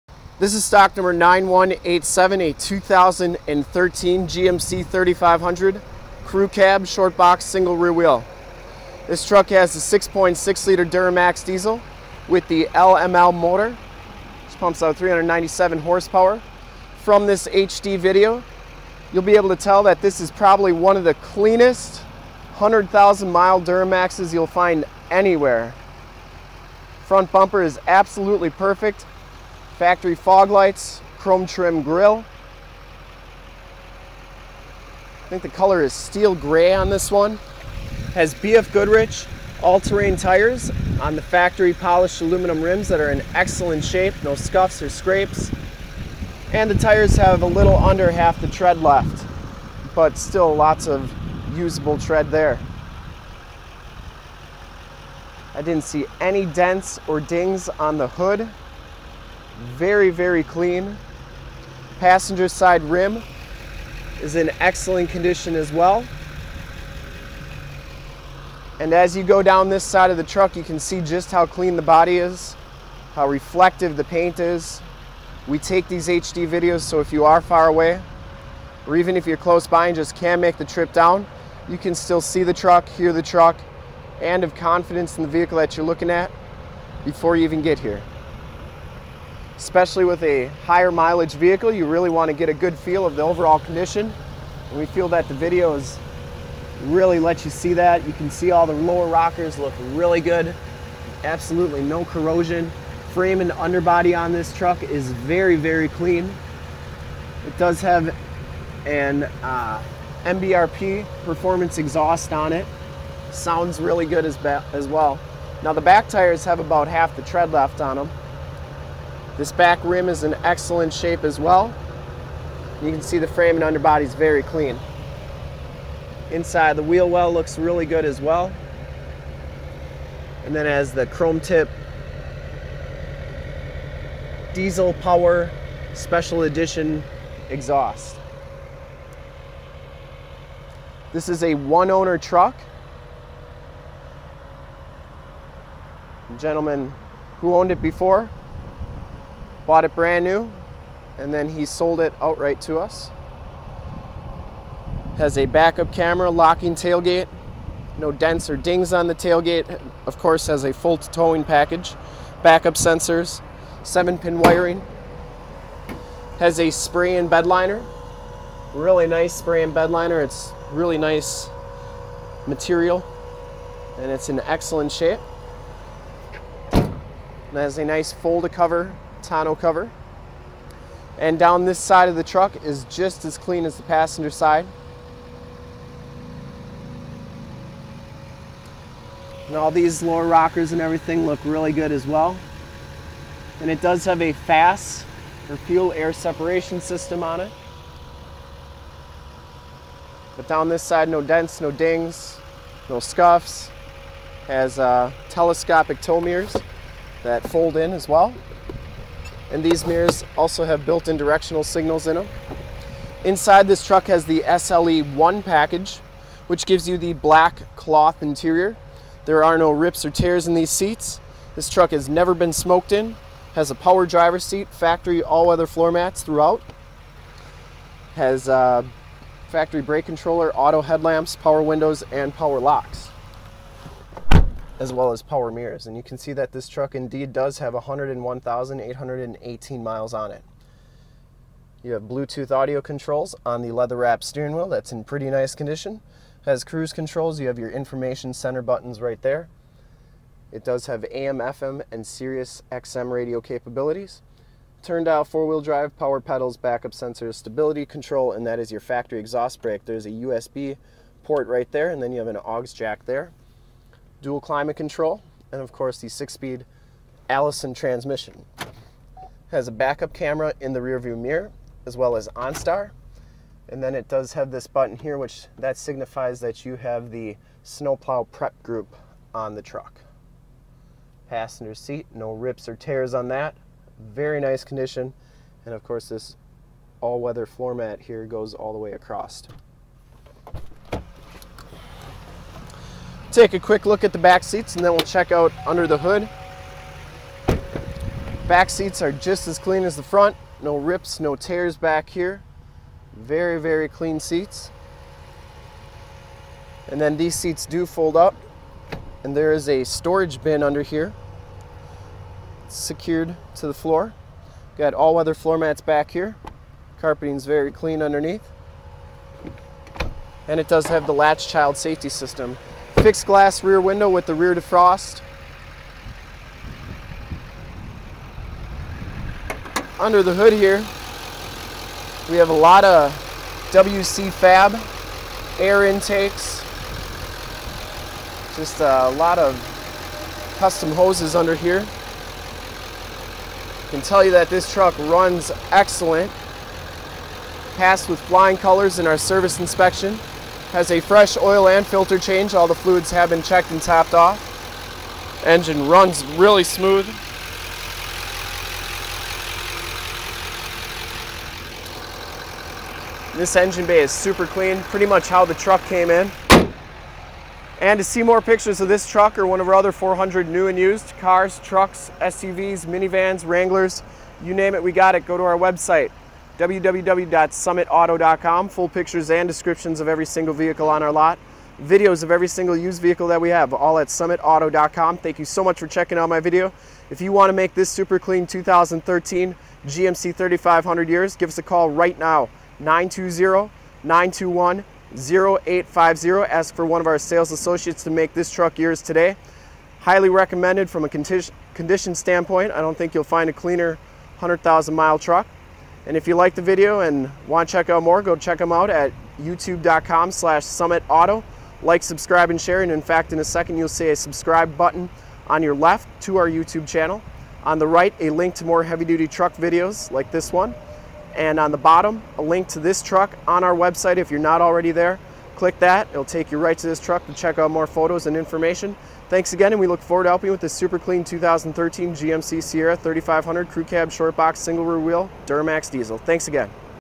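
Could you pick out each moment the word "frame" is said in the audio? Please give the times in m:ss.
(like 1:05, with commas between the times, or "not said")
1:43, 2:03.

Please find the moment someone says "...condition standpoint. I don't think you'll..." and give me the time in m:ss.
6:41.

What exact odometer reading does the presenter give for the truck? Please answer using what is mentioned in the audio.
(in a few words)
101,818.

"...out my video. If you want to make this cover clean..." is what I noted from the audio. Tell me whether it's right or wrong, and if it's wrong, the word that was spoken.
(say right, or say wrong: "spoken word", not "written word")
wrong: "super", not "cover".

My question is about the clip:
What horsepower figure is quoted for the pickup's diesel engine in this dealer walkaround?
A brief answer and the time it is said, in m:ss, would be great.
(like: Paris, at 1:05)
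397, at 0:14.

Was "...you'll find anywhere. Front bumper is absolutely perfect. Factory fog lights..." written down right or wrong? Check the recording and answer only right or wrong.
right.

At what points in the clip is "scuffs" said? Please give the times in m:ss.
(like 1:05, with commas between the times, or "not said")
0:44, 3:22.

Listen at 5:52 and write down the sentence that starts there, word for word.
All the fluids have been checked and topped off.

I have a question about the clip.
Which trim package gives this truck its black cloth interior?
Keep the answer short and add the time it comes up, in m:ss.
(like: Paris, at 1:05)
SLE1, at 3:34.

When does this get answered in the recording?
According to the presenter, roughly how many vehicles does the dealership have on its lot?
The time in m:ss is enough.
6:09.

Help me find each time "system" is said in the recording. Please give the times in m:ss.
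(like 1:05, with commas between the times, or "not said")
3:16, 5:22.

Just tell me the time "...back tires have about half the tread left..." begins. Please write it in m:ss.
1:55.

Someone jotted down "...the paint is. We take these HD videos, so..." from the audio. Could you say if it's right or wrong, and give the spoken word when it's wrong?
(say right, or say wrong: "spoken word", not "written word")
right.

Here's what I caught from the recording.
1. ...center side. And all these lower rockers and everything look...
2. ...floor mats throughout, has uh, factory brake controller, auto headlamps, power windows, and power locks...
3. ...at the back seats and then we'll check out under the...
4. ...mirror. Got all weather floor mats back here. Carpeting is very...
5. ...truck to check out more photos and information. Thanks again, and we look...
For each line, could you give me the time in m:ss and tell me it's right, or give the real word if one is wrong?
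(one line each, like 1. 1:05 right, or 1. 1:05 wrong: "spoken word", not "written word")
1. 3:03 wrong: "passenger", not "center"
2. 3:45 right
3. 4:54 right
4. 5:13 wrong: "floor", not "mirror"
5. 7:06 right.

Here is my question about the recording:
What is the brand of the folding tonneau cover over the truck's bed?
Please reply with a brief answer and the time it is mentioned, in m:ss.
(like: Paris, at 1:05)
Fold-A-Cover, at 2:58.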